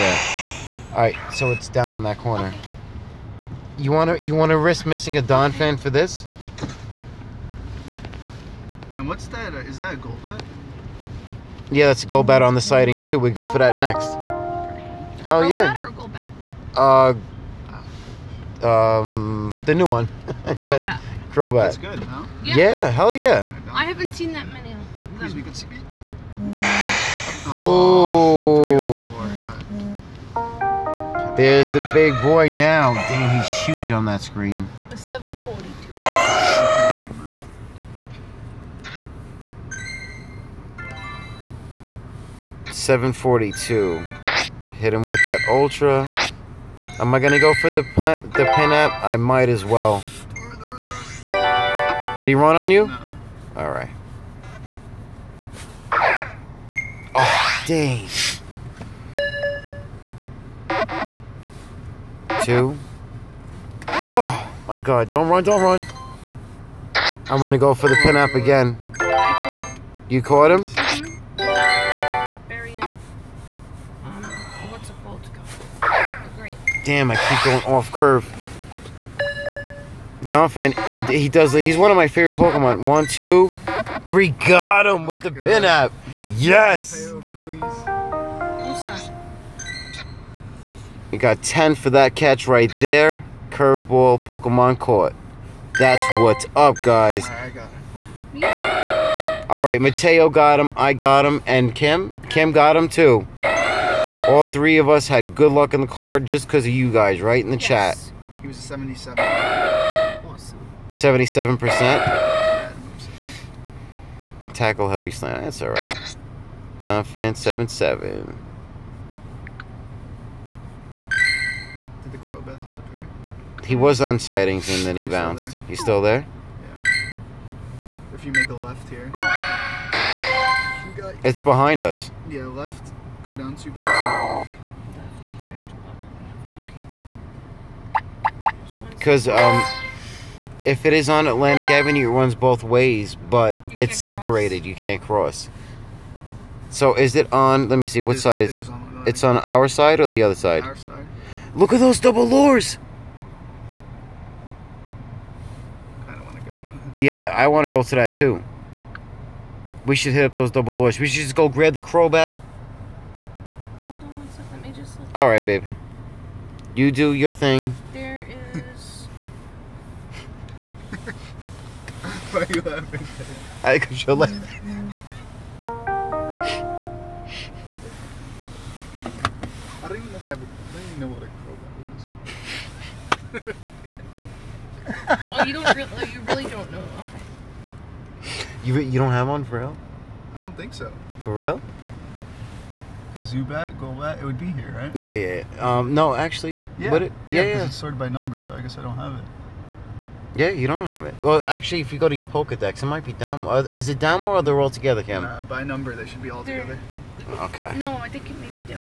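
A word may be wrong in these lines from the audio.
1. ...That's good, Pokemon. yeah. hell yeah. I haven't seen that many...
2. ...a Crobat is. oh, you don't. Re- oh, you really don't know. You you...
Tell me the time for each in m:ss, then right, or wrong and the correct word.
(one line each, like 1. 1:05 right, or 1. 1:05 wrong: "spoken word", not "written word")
1. 0:21 wrong: "Yeah", not "Pokemon"
2. 3:03 right.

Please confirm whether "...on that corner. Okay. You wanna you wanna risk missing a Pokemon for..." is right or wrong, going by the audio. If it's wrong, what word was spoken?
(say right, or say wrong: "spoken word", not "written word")
wrong: "Donphan", not "Pokemon".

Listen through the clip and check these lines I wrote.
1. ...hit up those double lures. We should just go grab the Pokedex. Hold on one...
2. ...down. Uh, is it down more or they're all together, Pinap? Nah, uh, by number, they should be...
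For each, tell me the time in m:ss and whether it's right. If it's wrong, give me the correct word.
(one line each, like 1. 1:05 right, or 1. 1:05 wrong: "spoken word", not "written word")
1. 2:40 wrong: "Crobat", not "Pokedex"
2. 3:23 wrong: "Kim", not "Pinap".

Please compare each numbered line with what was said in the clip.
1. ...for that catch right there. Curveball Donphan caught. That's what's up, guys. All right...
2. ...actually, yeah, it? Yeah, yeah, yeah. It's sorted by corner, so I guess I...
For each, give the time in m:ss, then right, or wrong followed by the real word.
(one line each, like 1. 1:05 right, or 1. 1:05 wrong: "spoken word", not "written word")
1. 1:31 wrong: "Pokemon", not "Donphan"
2. 3:16 wrong: "number", not "corner".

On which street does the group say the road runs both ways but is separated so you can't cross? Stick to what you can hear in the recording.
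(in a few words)
Atlantic Avenue.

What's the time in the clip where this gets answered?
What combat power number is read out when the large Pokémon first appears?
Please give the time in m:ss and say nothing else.
0:34.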